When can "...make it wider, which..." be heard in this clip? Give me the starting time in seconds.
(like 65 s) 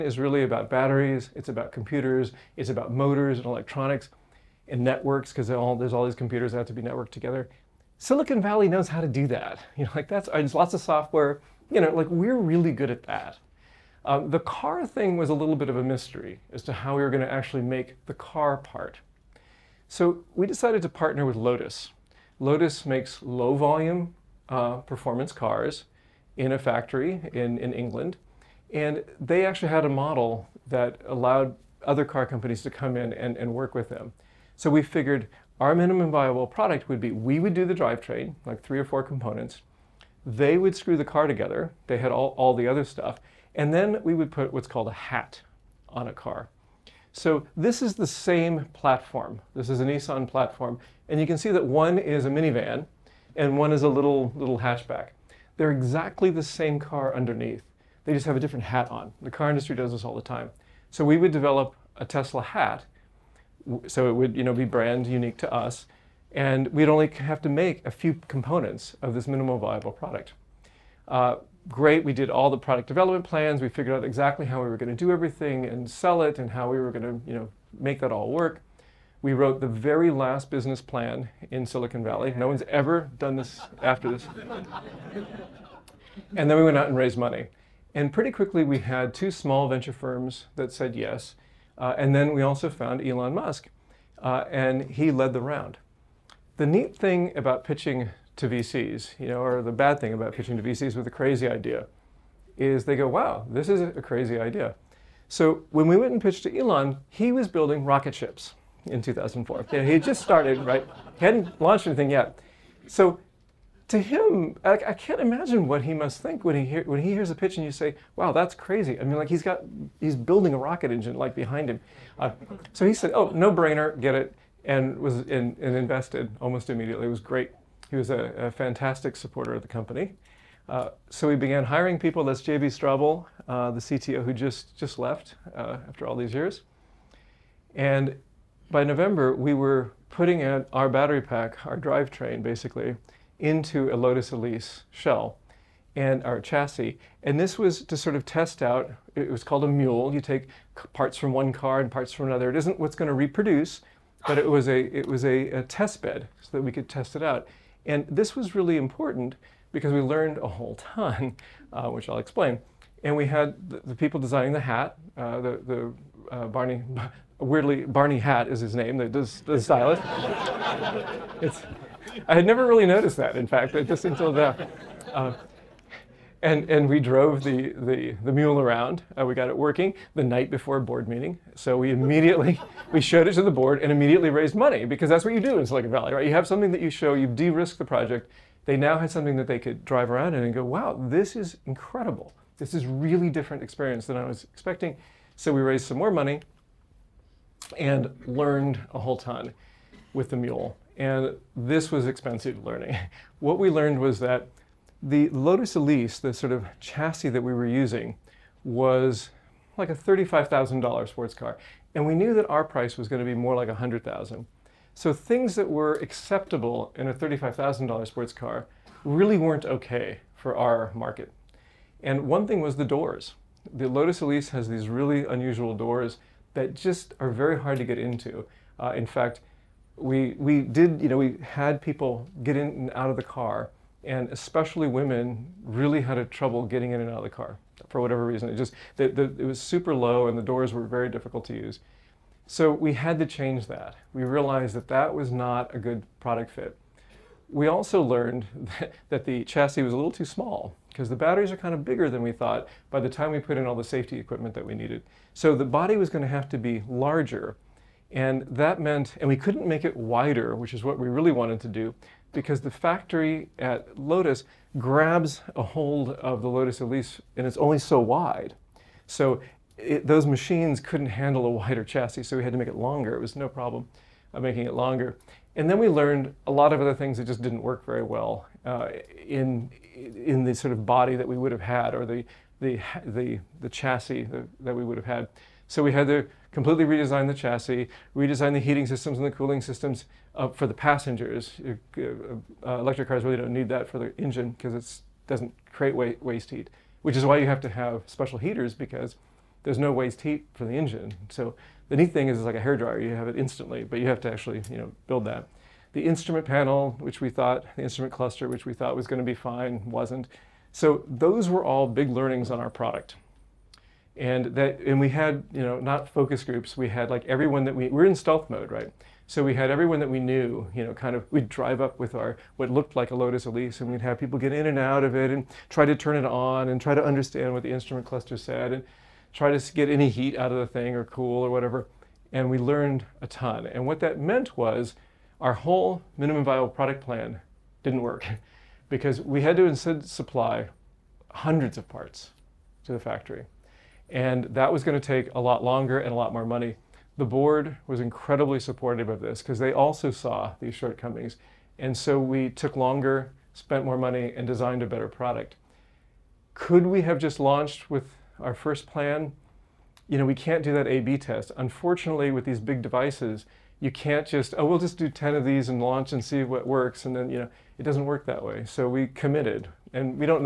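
259 s.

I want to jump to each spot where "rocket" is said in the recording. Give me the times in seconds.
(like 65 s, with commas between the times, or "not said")
107 s, 120 s.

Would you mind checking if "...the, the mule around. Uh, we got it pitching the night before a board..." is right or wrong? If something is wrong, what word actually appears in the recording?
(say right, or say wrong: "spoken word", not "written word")
wrong: "working", not "pitching".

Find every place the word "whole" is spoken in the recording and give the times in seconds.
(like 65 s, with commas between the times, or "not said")
160 s, 198 s, 335 s.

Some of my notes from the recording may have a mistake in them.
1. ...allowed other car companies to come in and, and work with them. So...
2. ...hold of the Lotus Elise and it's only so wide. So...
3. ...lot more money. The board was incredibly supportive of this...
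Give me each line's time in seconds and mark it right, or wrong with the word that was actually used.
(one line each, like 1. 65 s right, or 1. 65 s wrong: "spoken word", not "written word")
1. 31 s right
2. 265 s right
3. 346 s right.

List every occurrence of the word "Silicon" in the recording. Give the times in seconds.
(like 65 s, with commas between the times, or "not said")
7 s, 81 s, 185 s.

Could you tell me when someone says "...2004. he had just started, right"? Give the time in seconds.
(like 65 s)
109 s.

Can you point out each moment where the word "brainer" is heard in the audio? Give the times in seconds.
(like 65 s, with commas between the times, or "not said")
123 s.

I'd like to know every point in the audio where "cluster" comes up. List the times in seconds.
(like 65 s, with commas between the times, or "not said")
308 s, 328 s.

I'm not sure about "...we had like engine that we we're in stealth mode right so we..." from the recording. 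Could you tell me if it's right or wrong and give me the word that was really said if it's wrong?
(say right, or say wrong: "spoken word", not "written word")
wrong: "everyone", not "engine".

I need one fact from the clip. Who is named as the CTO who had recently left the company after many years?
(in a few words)
J.B. Straubel.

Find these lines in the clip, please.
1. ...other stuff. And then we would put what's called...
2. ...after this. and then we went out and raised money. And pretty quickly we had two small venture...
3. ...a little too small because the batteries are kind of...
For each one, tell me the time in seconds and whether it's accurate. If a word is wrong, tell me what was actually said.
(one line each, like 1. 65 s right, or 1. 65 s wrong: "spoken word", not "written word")
1. 42 s right
2. 83 s right
3. 249 s right.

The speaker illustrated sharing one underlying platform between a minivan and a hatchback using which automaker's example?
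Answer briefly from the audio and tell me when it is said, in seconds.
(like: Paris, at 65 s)
Nissan, at 49 s.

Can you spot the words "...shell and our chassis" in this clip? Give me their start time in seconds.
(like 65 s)
144 s.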